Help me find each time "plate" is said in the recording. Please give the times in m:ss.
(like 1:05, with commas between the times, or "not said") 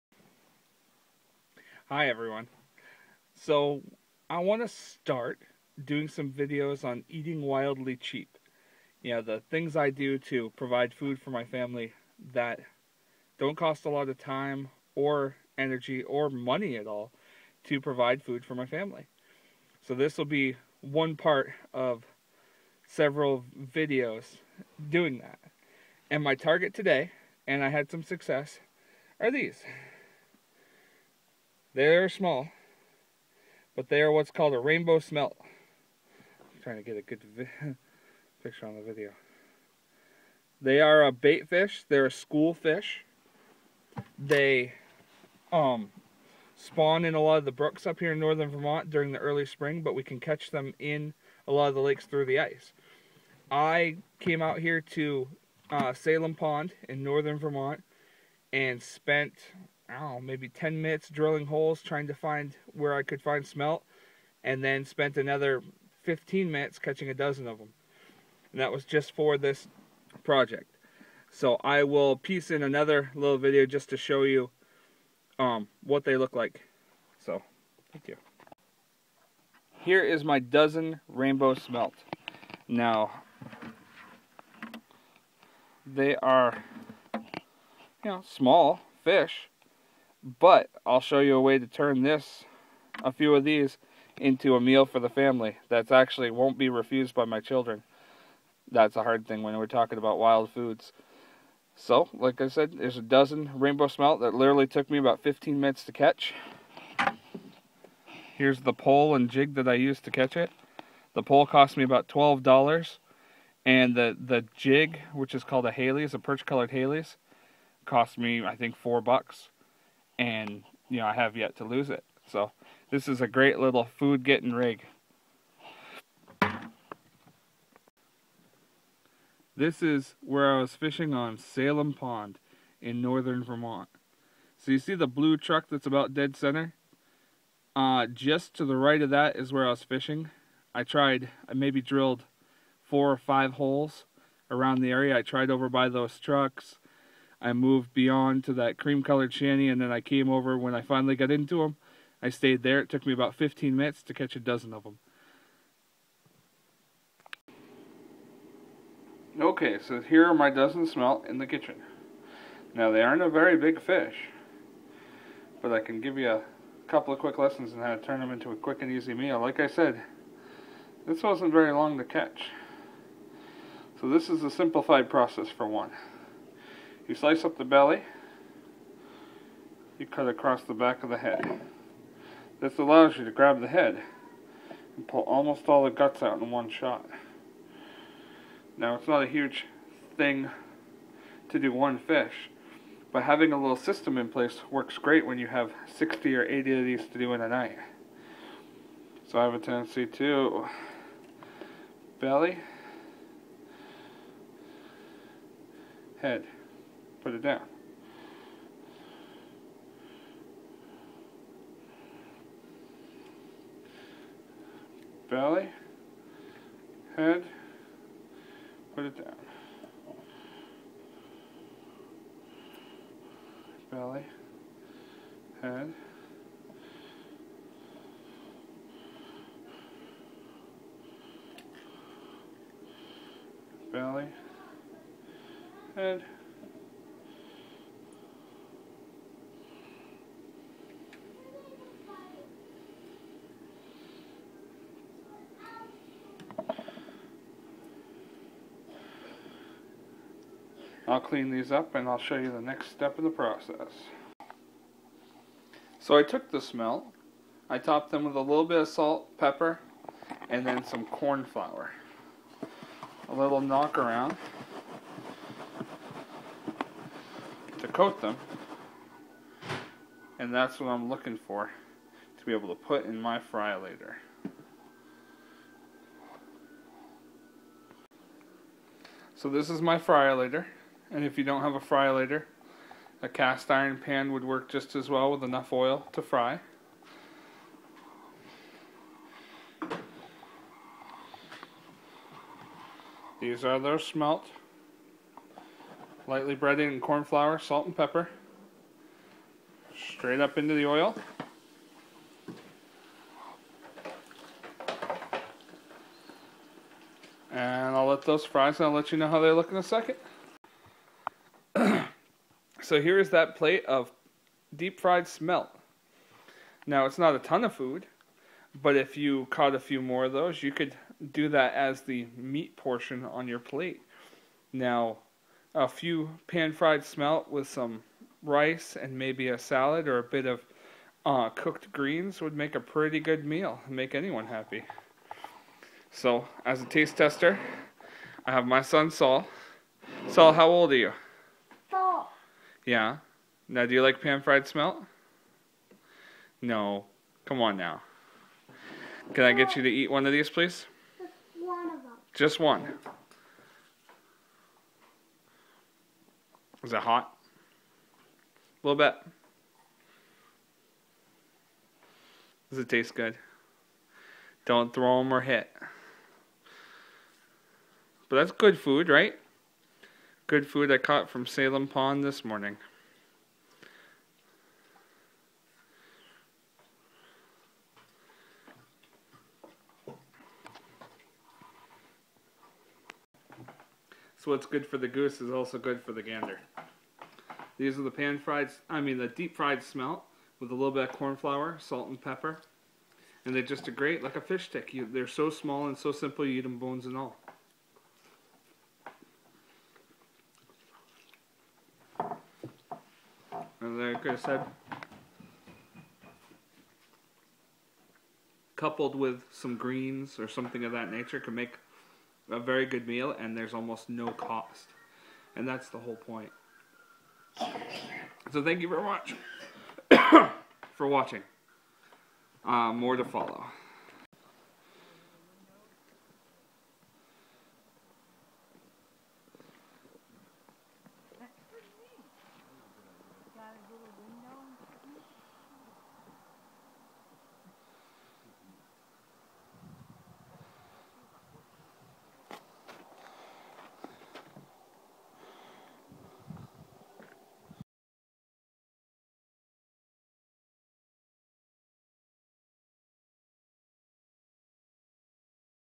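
5:13, 5:23.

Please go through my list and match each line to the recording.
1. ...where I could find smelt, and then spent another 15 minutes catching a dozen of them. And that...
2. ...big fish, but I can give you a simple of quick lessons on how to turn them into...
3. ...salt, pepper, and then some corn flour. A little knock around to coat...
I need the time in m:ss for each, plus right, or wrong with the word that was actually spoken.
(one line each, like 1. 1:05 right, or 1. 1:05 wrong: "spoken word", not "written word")
1. 1:02 right
2. 2:43 wrong: "couple", not "simple"
3. 4:18 right.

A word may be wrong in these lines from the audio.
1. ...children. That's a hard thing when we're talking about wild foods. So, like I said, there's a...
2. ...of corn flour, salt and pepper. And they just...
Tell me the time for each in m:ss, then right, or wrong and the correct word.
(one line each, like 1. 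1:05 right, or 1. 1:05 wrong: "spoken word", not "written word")
1. 1:37 right
2. 6:31 right.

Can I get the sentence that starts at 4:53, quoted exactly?
These are those smelt, lightly breaded in corn flour, salt, and pepper.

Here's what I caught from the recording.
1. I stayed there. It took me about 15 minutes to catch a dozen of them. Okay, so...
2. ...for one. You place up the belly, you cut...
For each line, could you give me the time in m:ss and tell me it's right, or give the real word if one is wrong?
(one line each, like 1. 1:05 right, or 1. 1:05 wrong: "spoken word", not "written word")
1. 2:32 right
2. 2:55 wrong: "slice", not "place".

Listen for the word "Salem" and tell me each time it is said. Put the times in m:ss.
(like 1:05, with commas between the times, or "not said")
0:55, 2:11, 6:11.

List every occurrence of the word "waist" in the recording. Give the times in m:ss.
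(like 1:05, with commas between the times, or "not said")
not said.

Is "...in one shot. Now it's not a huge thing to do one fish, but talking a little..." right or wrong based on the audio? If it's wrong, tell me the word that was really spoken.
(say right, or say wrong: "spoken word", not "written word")
wrong: "having", not "talking".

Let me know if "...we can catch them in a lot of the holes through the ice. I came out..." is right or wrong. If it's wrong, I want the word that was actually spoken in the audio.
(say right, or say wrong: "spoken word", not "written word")
wrong: "lakes", not "holes".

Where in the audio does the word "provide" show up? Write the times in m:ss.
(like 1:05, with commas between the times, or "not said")
0:10, 0:17.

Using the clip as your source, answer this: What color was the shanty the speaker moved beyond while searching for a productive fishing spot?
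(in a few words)
cream.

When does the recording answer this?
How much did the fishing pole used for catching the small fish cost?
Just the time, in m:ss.
1:52.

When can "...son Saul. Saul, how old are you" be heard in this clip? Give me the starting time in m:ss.
5:38.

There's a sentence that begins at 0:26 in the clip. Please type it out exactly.
And my target today, and I had some success, are these.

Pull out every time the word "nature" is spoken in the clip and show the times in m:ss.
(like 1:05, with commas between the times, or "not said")
6:51.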